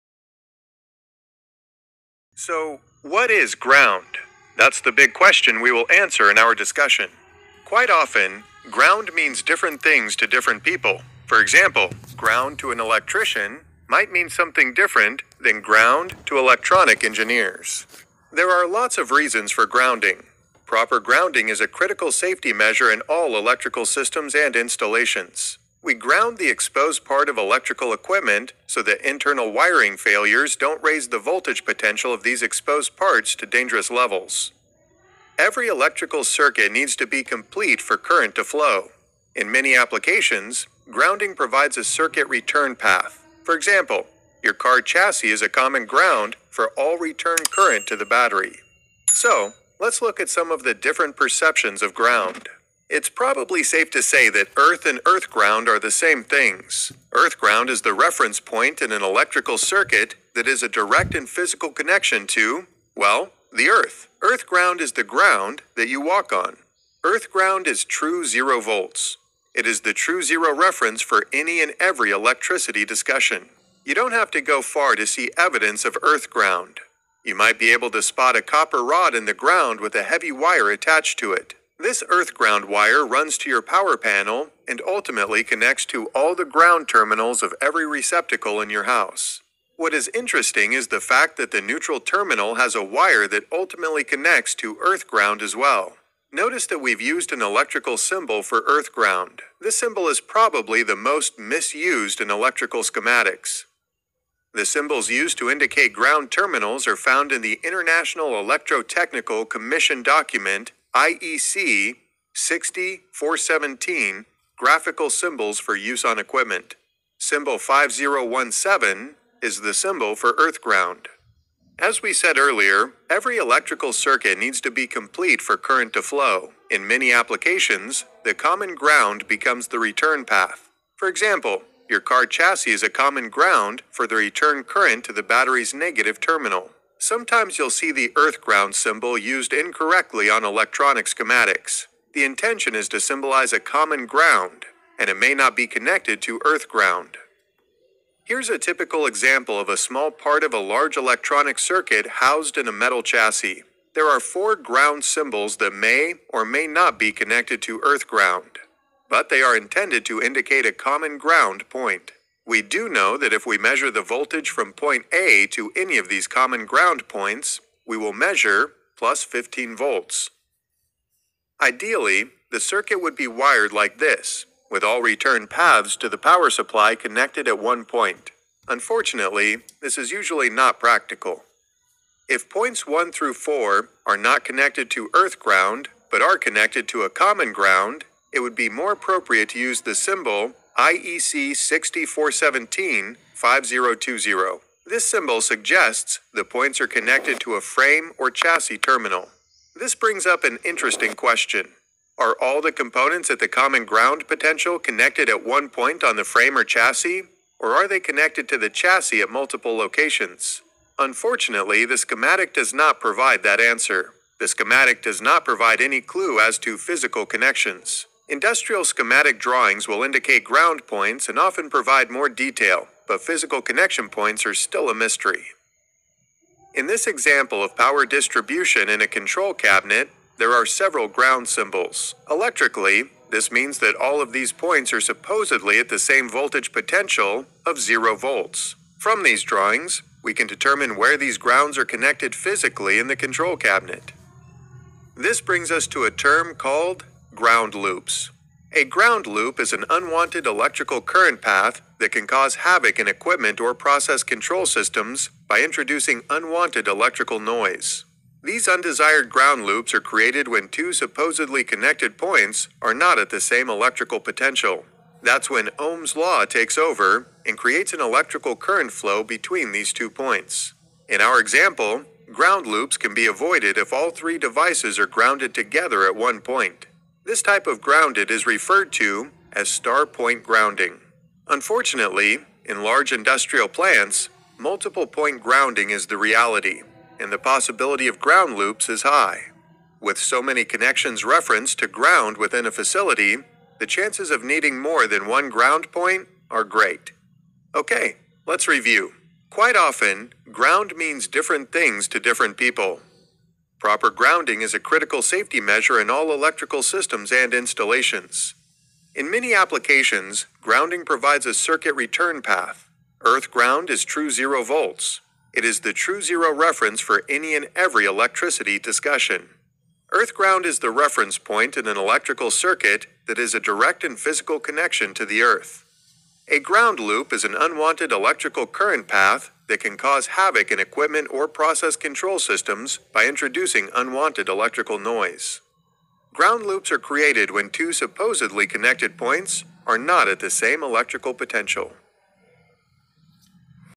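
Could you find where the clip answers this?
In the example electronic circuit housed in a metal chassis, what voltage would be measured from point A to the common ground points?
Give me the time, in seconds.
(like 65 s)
168 s.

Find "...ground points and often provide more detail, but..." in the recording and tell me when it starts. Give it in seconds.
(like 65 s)
220 s.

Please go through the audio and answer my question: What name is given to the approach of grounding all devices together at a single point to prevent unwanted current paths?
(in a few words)
Star point grounding.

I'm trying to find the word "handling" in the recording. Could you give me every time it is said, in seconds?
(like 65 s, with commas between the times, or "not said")
not said.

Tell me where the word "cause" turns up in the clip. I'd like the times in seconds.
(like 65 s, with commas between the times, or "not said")
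252 s, 329 s.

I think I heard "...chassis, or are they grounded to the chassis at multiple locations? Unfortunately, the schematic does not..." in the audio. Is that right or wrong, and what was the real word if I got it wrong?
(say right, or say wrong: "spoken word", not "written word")
wrong: "connected", not "grounded".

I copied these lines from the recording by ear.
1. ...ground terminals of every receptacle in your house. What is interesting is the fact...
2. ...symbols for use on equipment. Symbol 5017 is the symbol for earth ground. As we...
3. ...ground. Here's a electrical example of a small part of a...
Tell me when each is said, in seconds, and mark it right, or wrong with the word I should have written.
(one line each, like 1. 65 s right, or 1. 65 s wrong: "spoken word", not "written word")
1. 86 s right
2. 115 s right
3. 146 s wrong: "typical", not "electrical".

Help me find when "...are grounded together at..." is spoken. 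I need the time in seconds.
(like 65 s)
274 s.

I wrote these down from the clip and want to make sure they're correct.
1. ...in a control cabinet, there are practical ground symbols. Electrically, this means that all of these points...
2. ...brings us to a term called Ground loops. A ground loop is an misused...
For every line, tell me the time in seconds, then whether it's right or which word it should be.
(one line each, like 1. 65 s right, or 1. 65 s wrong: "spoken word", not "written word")
1. 228 s wrong: "several", not "practical"
2. 245 s wrong: "unwanted", not "misused".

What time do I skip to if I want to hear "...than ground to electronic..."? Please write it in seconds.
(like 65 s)
15 s.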